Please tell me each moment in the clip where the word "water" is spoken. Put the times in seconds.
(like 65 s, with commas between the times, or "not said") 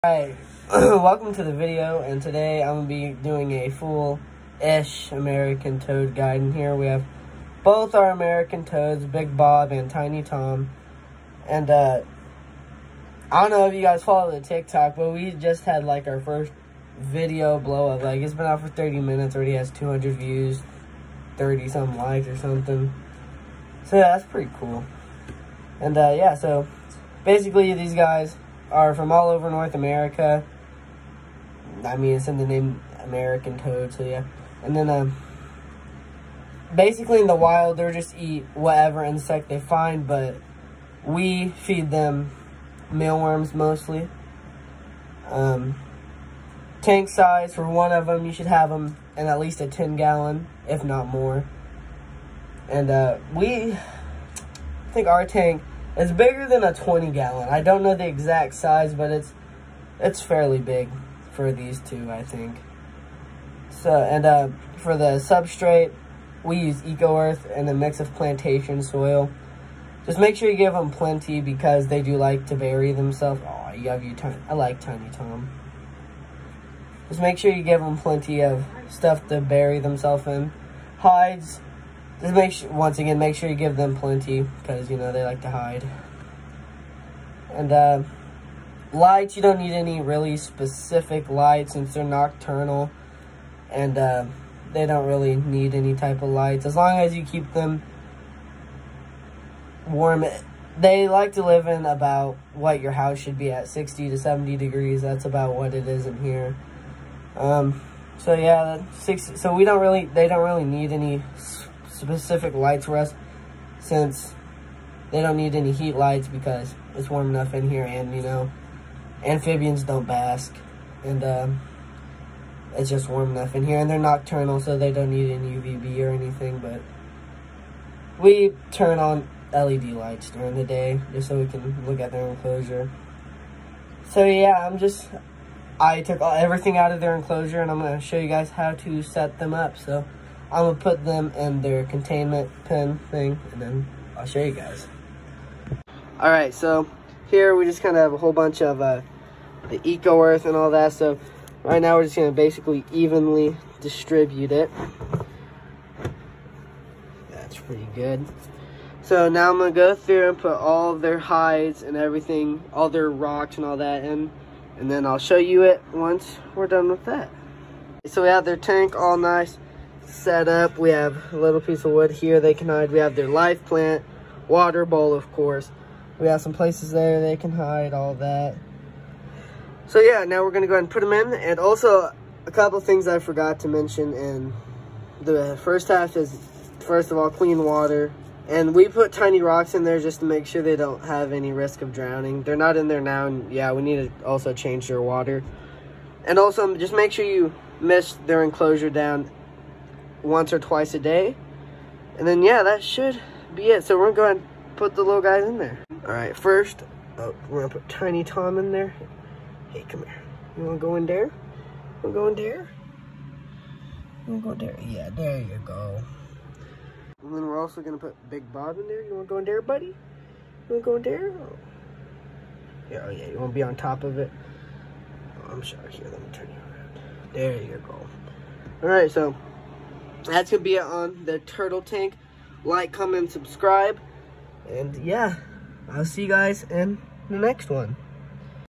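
174 s, 187 s, 195 s.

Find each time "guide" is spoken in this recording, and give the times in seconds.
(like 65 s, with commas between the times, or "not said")
6 s.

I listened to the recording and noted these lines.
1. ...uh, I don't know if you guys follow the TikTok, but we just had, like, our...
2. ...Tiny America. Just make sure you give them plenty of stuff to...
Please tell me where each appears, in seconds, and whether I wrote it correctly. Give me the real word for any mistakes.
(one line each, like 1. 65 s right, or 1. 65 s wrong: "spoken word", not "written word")
1. 11 s right
2. 74 s wrong: "Tom", not "America".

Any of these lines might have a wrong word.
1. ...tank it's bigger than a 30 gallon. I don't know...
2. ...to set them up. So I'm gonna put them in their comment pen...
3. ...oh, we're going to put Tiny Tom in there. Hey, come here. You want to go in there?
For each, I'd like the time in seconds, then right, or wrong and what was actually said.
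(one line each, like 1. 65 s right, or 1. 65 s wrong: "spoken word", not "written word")
1. 55 s wrong: "20", not "30"
2. 138 s wrong: "containment", not "comment"
3. 207 s right.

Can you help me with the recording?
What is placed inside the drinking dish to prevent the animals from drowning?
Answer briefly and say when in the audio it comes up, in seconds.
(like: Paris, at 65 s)
tiny rocks, at 189 s.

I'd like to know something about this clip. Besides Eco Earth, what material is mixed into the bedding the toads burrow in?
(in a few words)
plantation soil.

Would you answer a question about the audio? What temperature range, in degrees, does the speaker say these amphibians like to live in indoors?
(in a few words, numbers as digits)
60 to 70.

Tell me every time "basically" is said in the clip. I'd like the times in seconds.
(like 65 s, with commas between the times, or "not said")
27 s, 36 s, 152 s.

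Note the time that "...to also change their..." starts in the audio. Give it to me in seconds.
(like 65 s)
194 s.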